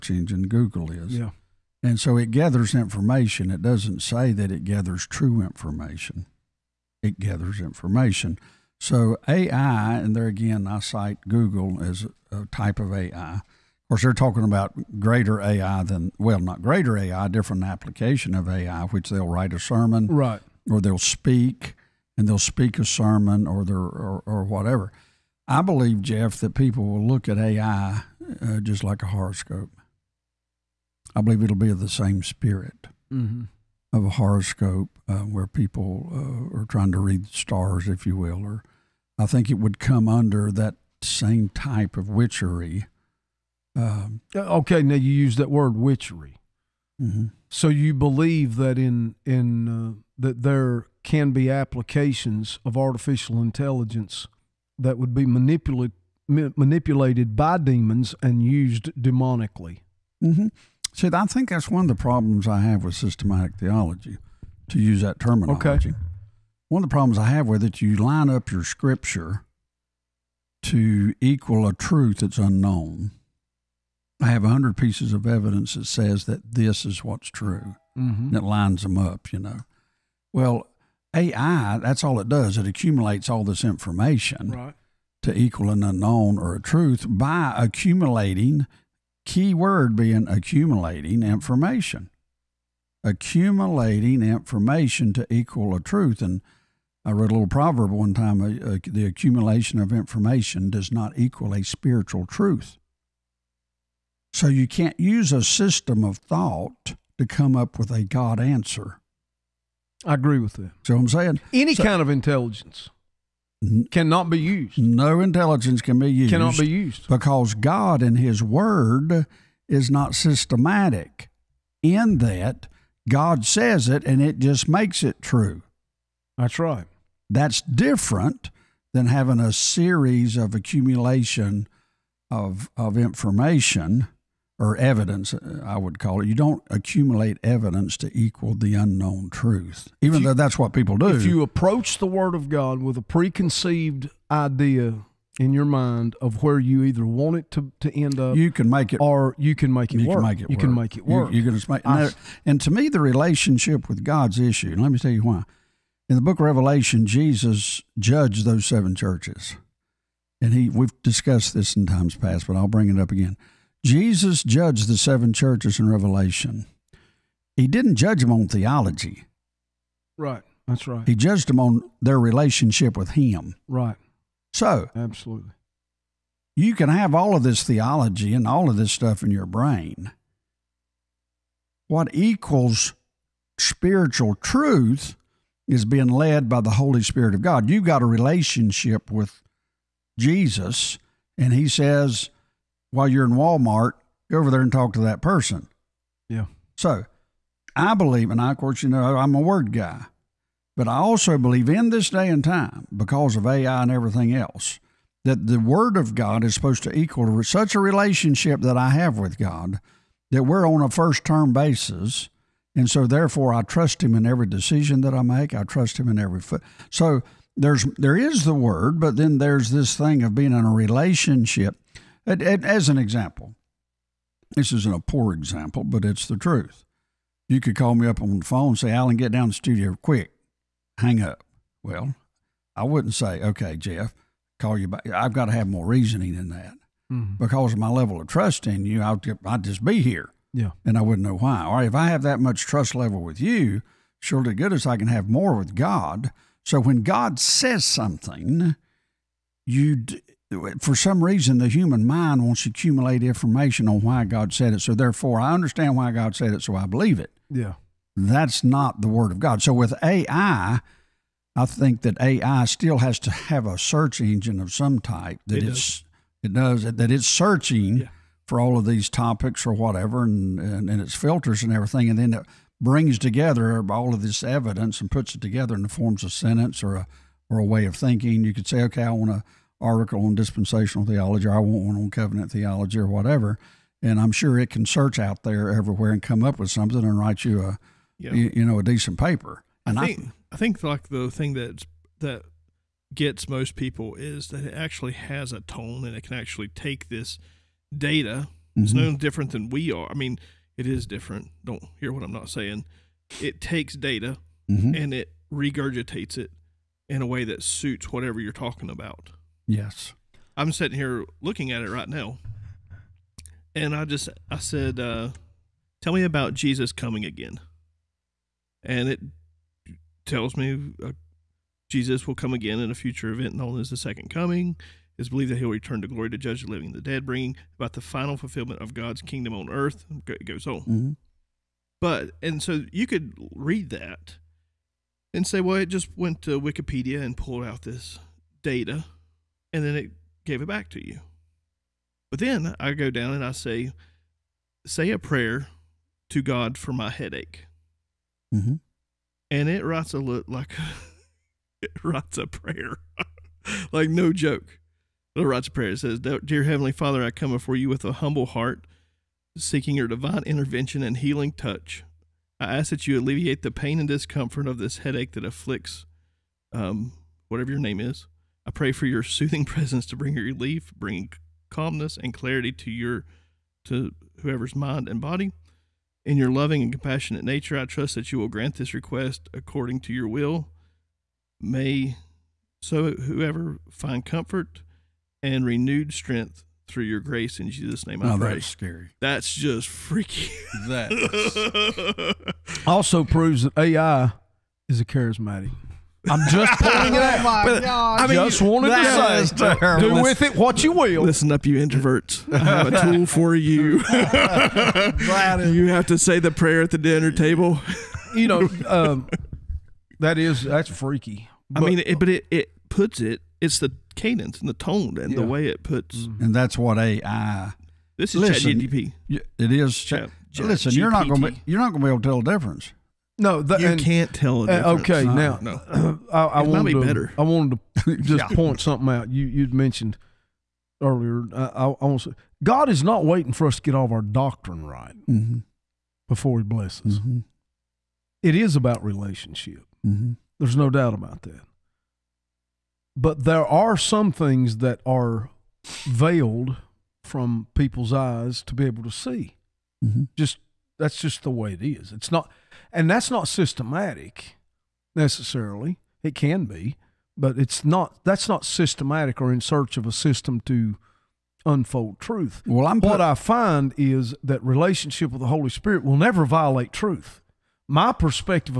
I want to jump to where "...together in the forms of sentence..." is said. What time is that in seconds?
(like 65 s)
275 s.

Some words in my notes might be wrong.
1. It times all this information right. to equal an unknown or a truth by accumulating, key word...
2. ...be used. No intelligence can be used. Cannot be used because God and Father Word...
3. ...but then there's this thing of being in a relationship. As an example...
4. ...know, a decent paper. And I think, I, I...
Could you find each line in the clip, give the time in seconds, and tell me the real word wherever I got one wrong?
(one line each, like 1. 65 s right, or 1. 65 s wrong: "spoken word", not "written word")
1. 82 s wrong: "accumulates", not "times"
2. 114 s wrong: "His", not "Father"
3. 218 s right
4. 288 s right.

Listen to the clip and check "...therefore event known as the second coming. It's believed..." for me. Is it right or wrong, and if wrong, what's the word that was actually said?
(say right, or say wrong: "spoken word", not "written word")
wrong: "future", not "therefore".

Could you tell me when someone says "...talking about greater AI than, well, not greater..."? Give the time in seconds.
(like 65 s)
14 s.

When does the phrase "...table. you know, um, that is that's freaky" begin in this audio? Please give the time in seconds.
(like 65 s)
407 s.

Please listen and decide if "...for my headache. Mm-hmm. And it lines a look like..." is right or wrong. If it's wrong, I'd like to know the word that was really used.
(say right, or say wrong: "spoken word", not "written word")
wrong: "writes", not "lines".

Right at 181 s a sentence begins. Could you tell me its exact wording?
What equals spiritual truth is being led by the Holy Spirit of God.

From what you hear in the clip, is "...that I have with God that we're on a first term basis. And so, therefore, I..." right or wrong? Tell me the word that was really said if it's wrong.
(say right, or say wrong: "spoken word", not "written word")
right.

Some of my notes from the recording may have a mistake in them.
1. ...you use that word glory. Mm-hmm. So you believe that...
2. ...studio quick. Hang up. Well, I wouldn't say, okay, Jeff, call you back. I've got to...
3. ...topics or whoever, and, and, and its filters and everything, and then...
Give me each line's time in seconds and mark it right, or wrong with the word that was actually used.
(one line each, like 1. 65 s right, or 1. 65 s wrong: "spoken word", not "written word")
1. 44 s wrong: "witchery", not "glory"
2. 229 s right
3. 269 s wrong: "whatever", not "whoever".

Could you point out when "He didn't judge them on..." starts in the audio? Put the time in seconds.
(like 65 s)
167 s.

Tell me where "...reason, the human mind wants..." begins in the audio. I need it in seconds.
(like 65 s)
251 s.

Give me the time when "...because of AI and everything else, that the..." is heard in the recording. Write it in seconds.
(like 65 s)
202 s.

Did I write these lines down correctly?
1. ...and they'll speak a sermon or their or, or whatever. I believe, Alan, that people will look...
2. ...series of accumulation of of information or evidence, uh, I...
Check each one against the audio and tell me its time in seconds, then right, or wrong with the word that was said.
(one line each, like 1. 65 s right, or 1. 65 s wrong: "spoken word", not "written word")
1. 22 s wrong: "Jeff", not "Alan"
2. 129 s right.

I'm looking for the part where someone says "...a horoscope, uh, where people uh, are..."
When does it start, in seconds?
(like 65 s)
34 s.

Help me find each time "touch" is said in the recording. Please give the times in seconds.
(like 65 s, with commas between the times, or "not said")
361 s.